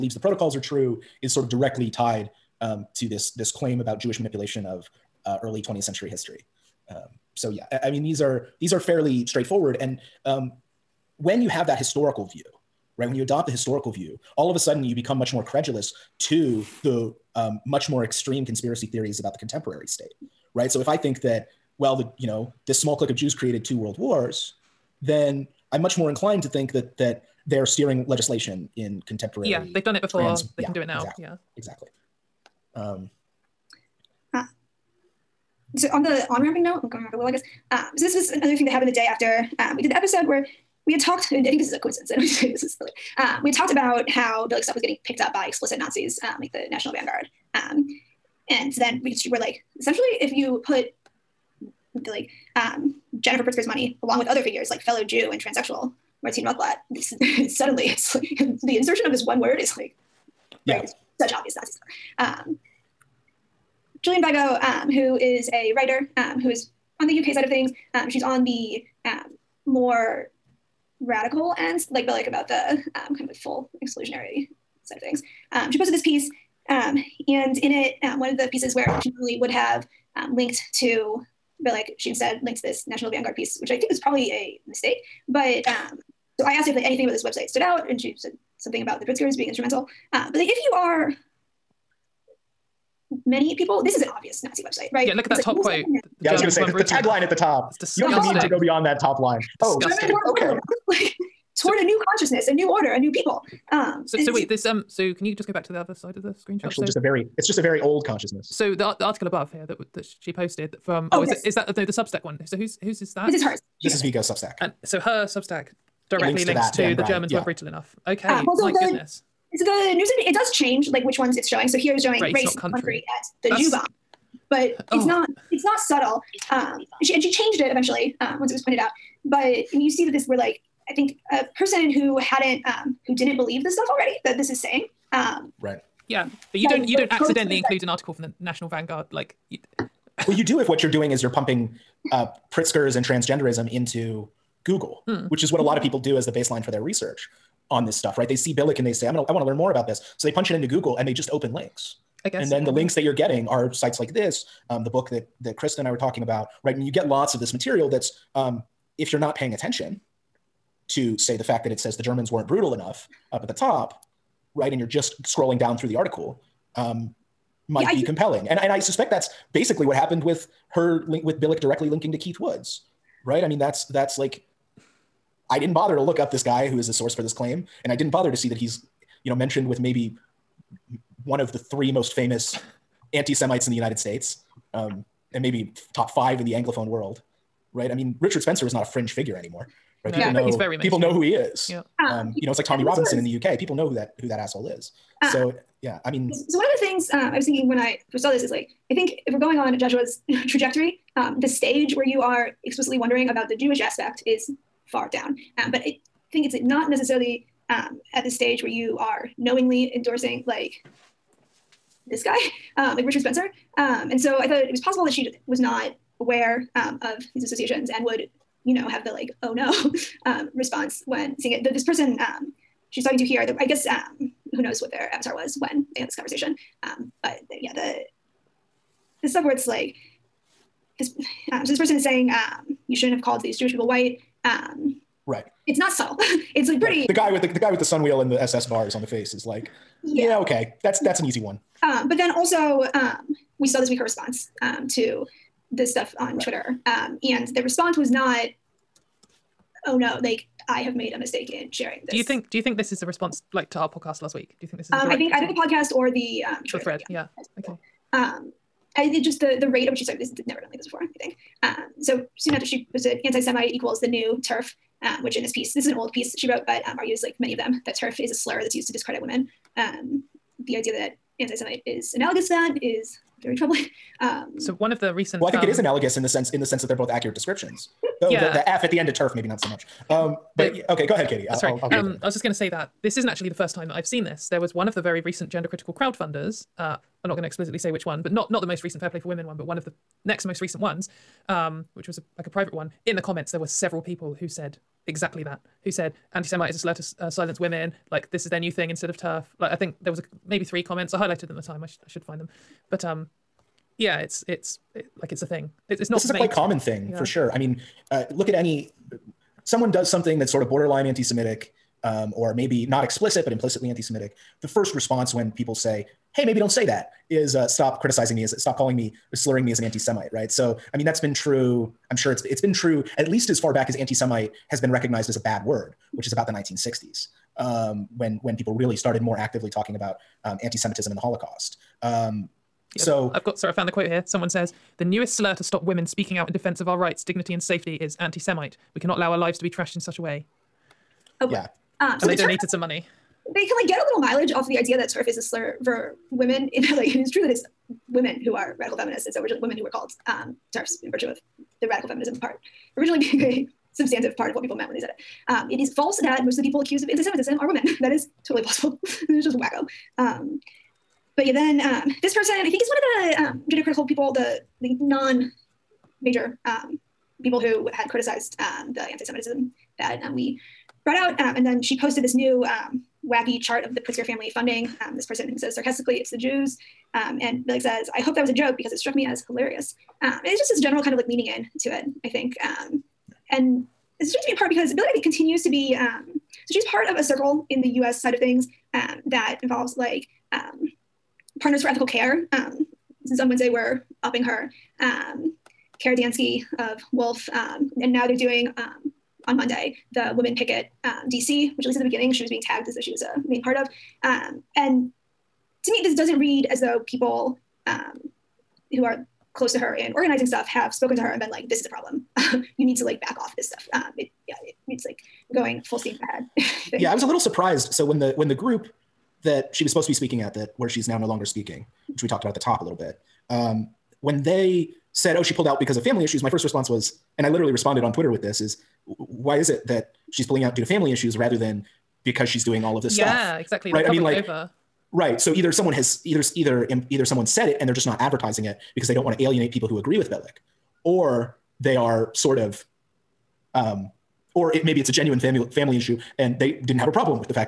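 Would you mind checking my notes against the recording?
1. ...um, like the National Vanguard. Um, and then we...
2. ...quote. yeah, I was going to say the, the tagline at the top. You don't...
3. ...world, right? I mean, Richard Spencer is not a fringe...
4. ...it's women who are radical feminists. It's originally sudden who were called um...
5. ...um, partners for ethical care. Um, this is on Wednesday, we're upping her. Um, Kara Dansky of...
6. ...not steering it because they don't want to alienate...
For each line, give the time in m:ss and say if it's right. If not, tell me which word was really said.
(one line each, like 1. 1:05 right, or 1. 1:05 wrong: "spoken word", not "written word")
1. 0:46 right
2. 1:35 right
3. 3:06 right
4. 5:47 wrong: "women", not "sudden"
5. 6:30 right
6. 7:18 wrong: "advertising", not "steering".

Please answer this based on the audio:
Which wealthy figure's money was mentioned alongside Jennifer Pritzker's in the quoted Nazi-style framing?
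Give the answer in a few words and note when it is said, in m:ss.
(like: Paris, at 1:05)
Martine Rothblatt, at 0:56.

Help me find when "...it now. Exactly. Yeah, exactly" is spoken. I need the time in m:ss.
0:30.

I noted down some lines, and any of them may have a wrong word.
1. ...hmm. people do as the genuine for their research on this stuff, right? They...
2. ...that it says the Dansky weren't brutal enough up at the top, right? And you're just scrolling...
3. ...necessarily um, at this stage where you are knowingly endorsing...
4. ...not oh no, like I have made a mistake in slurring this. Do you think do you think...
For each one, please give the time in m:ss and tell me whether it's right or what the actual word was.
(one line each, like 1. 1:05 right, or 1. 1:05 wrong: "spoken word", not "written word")
1. 2:25 wrong: "baseline", not "genuine"
2. 2:41 wrong: "Germans", not "Dansky"
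3. 3:26 right
4. 4:08 wrong: "sharing", not "slurring".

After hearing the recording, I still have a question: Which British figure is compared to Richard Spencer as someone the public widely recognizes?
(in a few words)
Tommy Robinson.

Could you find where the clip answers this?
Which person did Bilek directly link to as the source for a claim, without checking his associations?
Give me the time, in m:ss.
2:52.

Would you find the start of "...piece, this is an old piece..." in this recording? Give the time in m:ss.
4:25.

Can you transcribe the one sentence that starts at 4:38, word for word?
the, the, F at the end of turf maybe not so much.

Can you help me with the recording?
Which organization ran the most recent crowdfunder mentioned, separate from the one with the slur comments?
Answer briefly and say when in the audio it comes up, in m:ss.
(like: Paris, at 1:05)
Fair Play for Women, at 4:49.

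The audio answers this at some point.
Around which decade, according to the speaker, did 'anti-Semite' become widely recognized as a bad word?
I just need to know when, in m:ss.
5:26.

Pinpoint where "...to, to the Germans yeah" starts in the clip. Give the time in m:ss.
1:56.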